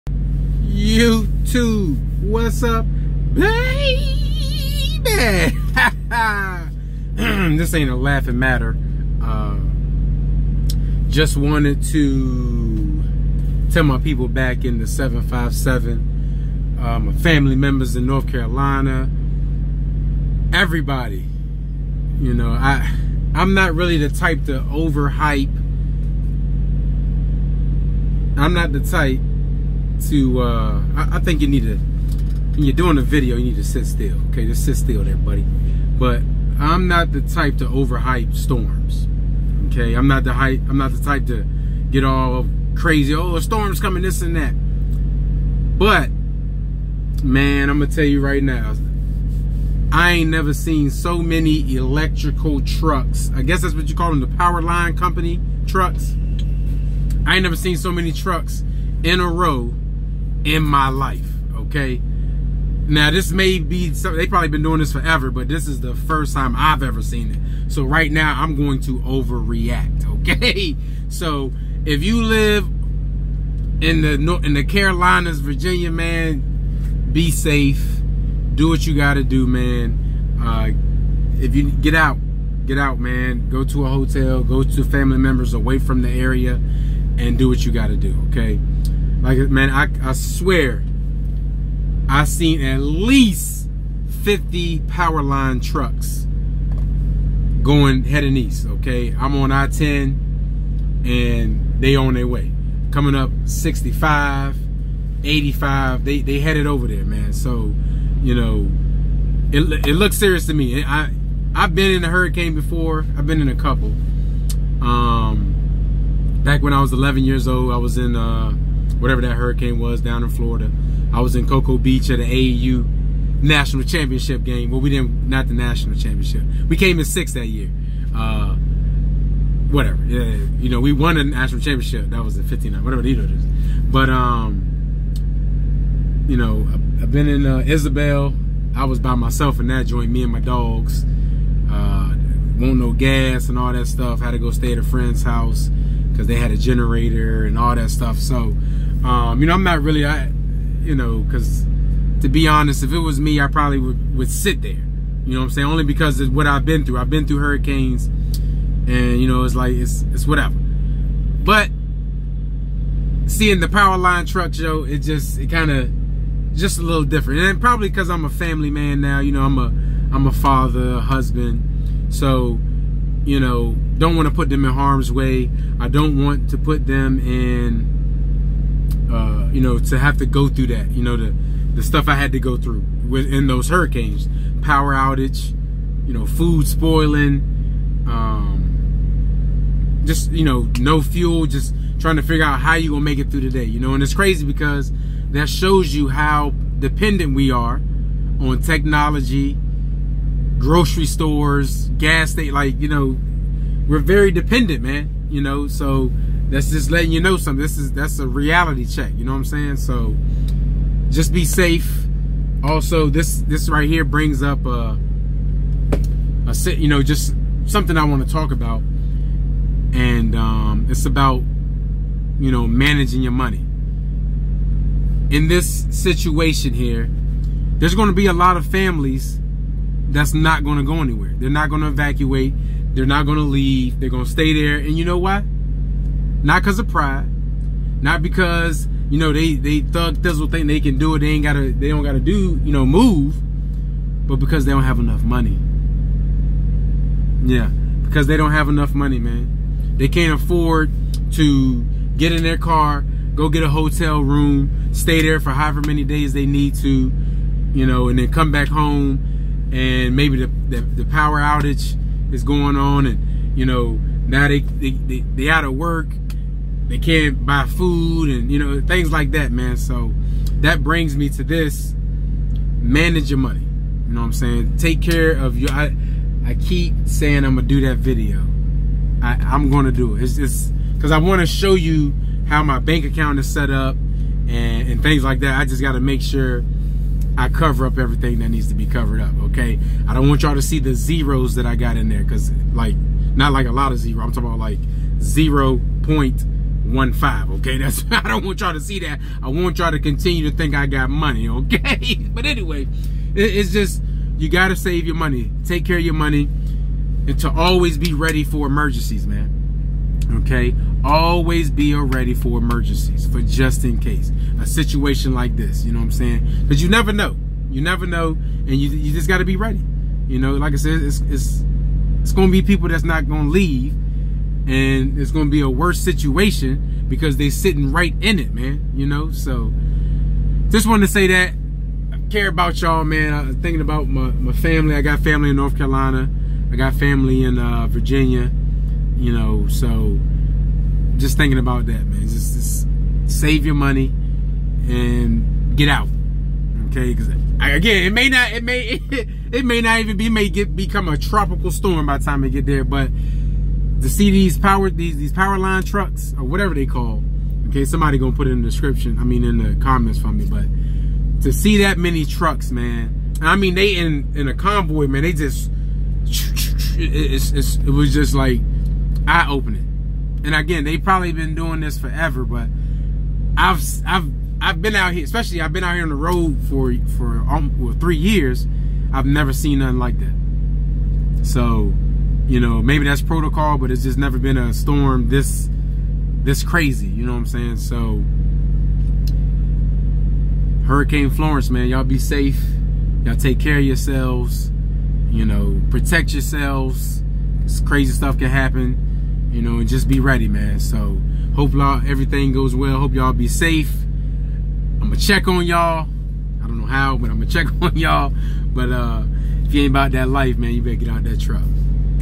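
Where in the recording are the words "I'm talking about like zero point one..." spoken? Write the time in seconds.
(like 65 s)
294 s.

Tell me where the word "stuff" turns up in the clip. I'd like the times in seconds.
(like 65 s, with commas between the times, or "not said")
143 s, 147 s, 181 s, 398 s.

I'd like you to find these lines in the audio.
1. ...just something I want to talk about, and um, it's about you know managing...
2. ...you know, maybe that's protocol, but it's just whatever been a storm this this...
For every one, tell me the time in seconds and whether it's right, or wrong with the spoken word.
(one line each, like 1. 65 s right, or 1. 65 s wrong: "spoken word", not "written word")
1. 217 s right
2. 382 s wrong: "never", not "whatever".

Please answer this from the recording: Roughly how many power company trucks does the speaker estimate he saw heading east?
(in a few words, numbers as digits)
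50.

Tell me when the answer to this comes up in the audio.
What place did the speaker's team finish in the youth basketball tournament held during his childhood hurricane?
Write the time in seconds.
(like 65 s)
127 s.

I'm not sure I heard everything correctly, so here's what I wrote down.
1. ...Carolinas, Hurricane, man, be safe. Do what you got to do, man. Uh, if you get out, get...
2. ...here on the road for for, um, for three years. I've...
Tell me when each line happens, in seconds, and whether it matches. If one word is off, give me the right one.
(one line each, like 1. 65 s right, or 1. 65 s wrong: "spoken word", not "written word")
1. 74 s wrong: "Virginia", not "Hurricane"
2. 375 s right.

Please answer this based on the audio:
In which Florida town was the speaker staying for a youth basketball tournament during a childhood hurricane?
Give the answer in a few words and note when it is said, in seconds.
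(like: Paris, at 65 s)
Cocoa Beach, at 121 s.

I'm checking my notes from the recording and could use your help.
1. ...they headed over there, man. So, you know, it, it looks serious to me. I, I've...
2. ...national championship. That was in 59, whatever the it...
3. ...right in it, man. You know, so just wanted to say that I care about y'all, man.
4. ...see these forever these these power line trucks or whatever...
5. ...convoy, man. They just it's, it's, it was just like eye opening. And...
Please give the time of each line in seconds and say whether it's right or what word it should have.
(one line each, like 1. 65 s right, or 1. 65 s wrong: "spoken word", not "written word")
1. 106 s right
2. 131 s right
3. 327 s right
4. 354 s wrong: "power", not "forever"
5. 364 s right.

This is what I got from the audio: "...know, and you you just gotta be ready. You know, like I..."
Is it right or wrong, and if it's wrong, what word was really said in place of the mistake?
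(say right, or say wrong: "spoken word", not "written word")
right.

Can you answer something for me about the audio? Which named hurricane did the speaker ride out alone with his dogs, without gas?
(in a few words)
Isabel.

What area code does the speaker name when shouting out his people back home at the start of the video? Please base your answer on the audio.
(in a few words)
757.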